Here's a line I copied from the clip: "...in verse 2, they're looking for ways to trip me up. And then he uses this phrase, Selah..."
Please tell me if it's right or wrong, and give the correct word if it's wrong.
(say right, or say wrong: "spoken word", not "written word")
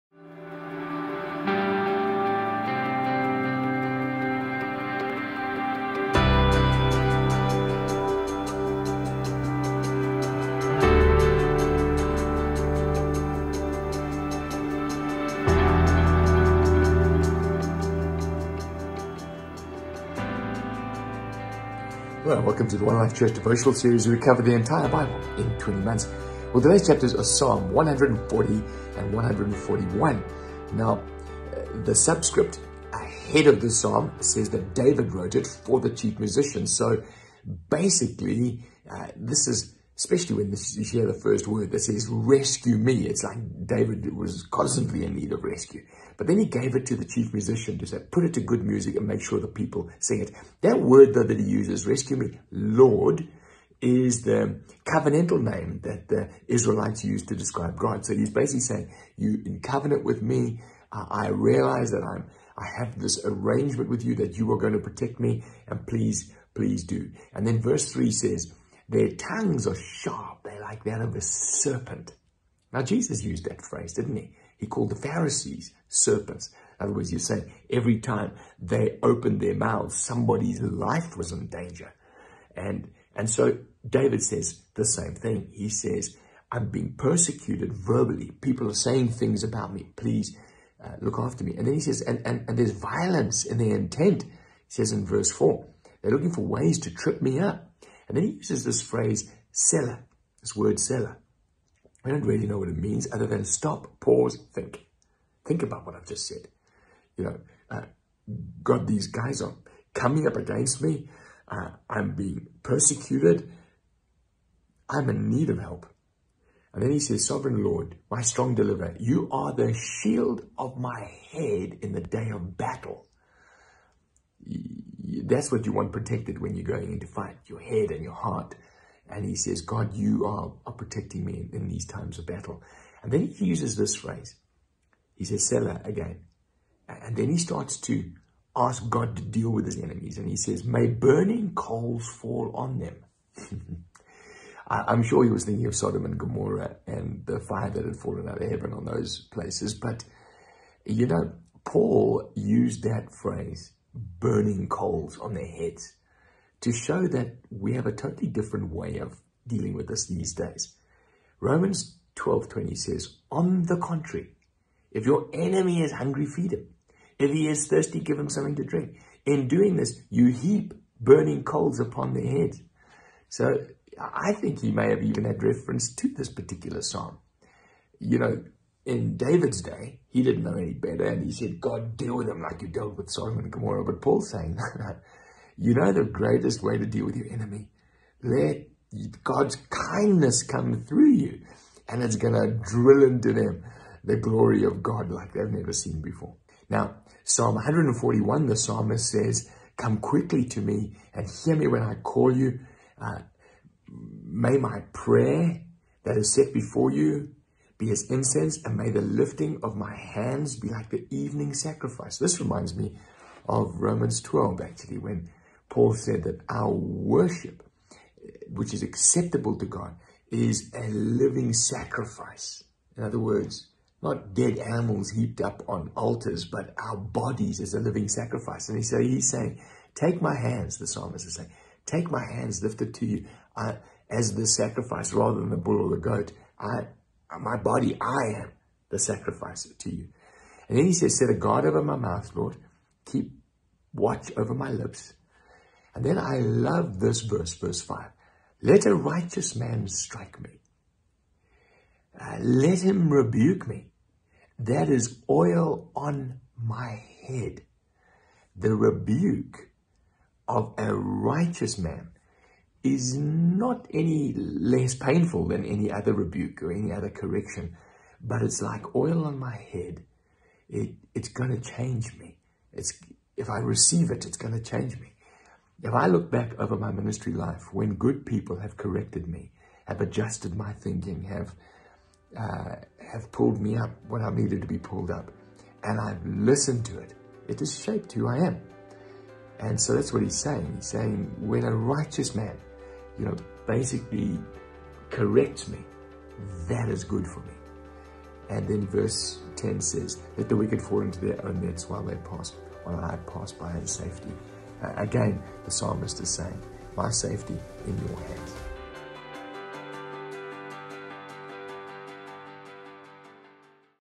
wrong: "4", not "2".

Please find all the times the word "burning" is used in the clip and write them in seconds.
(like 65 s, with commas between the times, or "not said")
140 s, 153 s, 170 s.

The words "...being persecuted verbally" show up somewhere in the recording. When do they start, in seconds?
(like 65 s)
86 s.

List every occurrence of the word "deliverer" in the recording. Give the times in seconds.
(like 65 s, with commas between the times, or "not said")
118 s.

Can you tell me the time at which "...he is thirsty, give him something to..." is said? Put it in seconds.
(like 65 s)
167 s.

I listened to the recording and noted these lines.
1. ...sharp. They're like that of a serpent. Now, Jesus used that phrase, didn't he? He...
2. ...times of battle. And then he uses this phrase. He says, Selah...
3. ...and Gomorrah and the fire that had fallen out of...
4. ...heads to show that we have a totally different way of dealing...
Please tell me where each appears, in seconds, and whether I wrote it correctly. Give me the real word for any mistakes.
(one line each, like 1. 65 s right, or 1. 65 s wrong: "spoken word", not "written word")
1. 69 s right
2. 131 s right
3. 146 s right
4. 155 s right.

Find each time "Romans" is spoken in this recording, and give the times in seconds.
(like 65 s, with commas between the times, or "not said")
161 s, 213 s.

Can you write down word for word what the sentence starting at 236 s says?
I uh, my body, I am the sacrifice to you.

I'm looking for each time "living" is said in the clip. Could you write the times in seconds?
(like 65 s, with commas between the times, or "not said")
220 s, 227 s.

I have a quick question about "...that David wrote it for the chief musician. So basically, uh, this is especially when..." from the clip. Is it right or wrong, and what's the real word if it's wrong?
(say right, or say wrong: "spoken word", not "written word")
right.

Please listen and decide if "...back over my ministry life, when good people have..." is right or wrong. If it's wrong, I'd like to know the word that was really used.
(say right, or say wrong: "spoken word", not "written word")
right.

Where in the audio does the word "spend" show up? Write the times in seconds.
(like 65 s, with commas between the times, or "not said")
not said.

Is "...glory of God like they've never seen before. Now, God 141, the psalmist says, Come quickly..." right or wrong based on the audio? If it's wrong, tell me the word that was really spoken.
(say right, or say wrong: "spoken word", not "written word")
wrong: "Psalm", not "God".